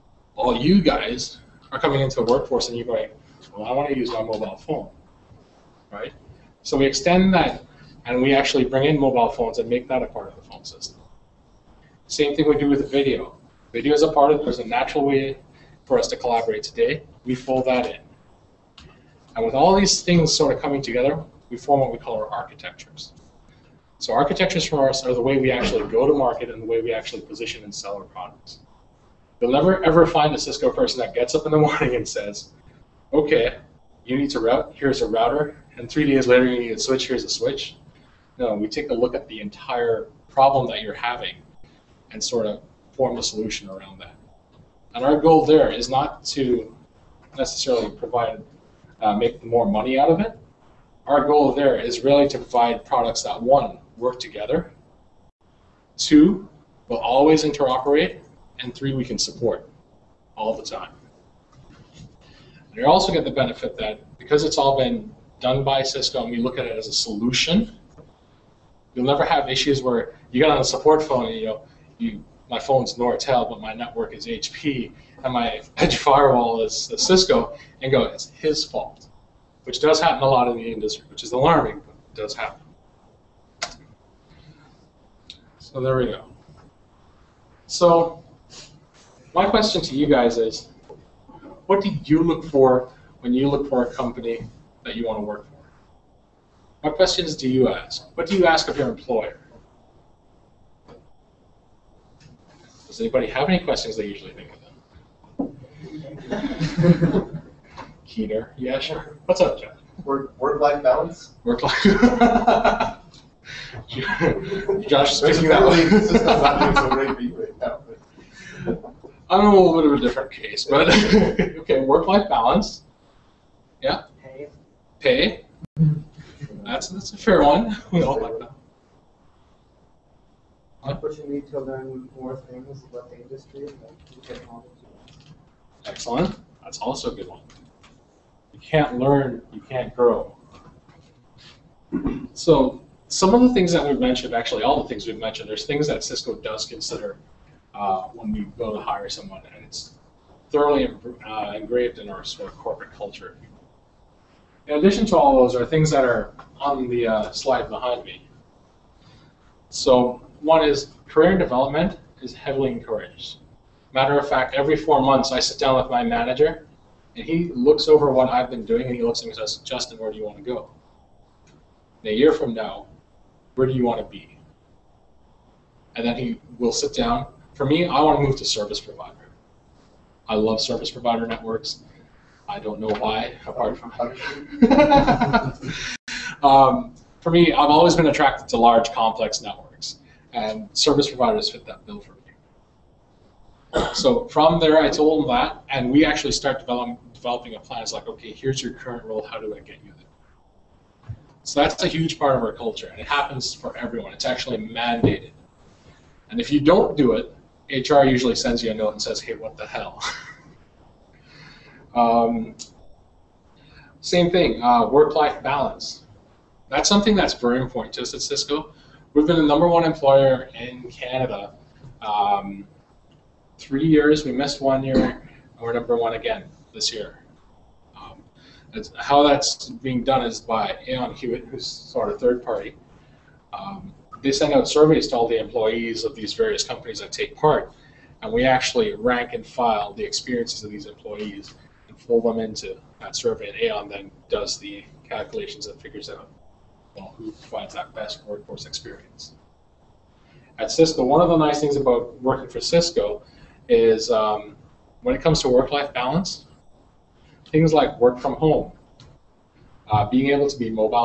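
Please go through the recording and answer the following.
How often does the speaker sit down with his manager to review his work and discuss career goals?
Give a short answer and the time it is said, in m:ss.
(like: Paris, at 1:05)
Every 4 months, at 2:44.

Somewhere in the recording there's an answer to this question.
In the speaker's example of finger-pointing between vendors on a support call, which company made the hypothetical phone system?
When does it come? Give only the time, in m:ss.
1:12.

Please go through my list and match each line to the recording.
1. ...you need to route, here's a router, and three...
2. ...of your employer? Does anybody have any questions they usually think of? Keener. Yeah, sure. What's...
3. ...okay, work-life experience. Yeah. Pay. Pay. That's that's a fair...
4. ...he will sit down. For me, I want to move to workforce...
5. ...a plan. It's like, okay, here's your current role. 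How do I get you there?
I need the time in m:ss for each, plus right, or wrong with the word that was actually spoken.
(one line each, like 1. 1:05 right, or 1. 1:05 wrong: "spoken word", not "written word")
1. 0:34 right
2. 1:38 right
3. 2:01 wrong: "balance", not "experience"
4. 2:56 wrong: "service", not "workforce"
5. 3:17 right.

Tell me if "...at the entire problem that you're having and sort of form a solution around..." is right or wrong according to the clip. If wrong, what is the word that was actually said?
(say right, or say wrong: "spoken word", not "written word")
right.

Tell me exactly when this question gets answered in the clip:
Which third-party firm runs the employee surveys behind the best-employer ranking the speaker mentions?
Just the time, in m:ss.
3:50.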